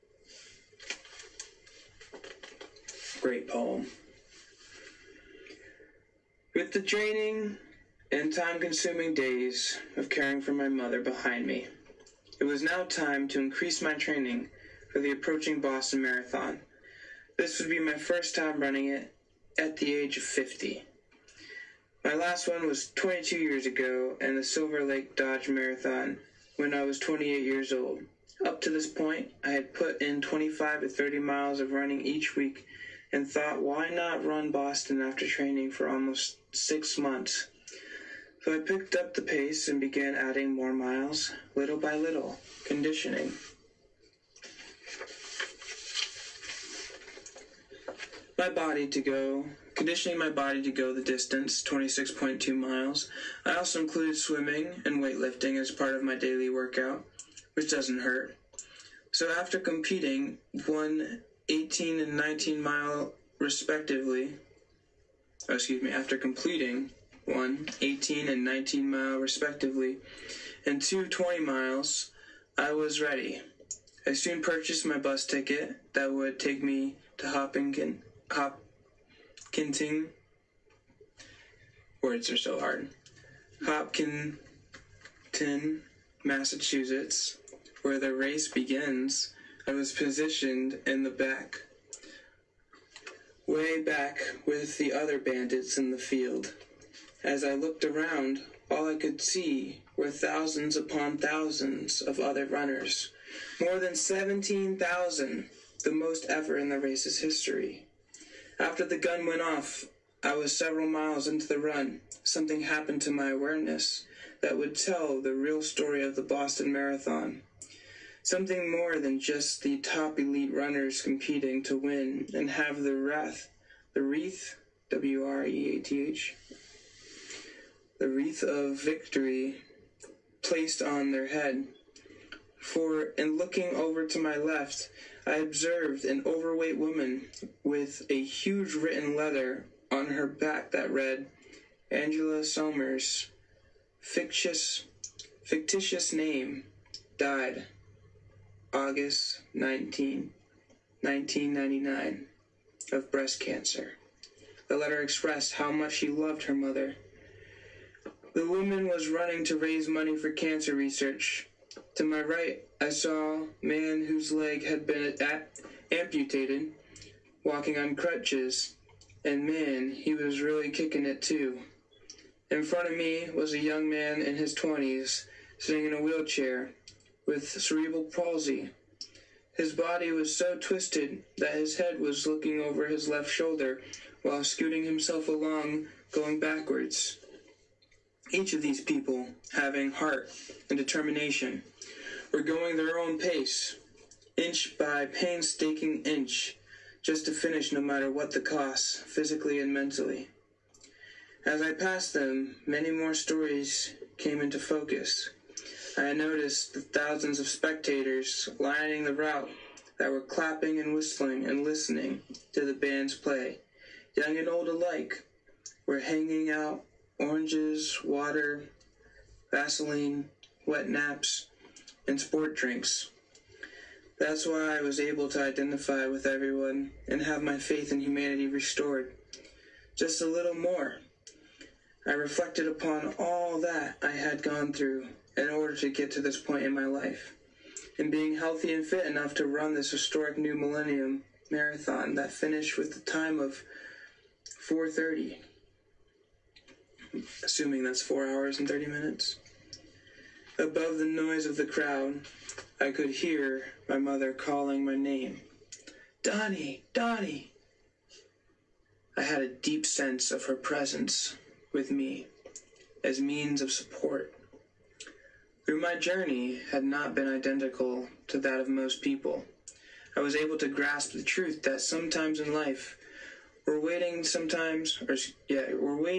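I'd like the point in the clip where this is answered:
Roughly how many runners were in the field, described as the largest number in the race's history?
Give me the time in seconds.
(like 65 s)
103 s.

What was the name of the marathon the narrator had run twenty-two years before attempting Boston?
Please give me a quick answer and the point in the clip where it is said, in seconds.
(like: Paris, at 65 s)
Silver Lake Dodge Marathon, at 24 s.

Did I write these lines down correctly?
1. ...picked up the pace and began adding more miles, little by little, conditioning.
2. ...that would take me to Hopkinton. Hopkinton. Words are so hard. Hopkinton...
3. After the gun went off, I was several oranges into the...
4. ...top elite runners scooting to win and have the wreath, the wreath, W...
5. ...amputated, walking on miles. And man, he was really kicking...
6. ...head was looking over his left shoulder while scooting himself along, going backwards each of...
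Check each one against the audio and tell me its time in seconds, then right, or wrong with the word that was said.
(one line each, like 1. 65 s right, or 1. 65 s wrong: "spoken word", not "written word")
1. 38 s right
2. 75 s right
3. 108 s wrong: "miles", not "oranges"
4. 119 s wrong: "competing", not "scooting"
5. 165 s wrong: "crutches", not "miles"
6. 181 s right.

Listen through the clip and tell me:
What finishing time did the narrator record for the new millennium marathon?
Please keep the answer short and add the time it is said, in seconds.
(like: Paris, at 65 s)
4:30, at 244 s.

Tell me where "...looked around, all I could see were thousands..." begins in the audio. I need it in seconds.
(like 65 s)
97 s.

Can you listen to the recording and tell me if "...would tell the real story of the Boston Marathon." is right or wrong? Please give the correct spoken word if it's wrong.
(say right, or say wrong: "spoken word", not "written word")
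right.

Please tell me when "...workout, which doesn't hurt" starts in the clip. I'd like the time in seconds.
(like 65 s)
56 s.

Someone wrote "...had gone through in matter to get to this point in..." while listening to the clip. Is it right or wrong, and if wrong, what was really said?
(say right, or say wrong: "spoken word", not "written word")
wrong: "order", not "matter".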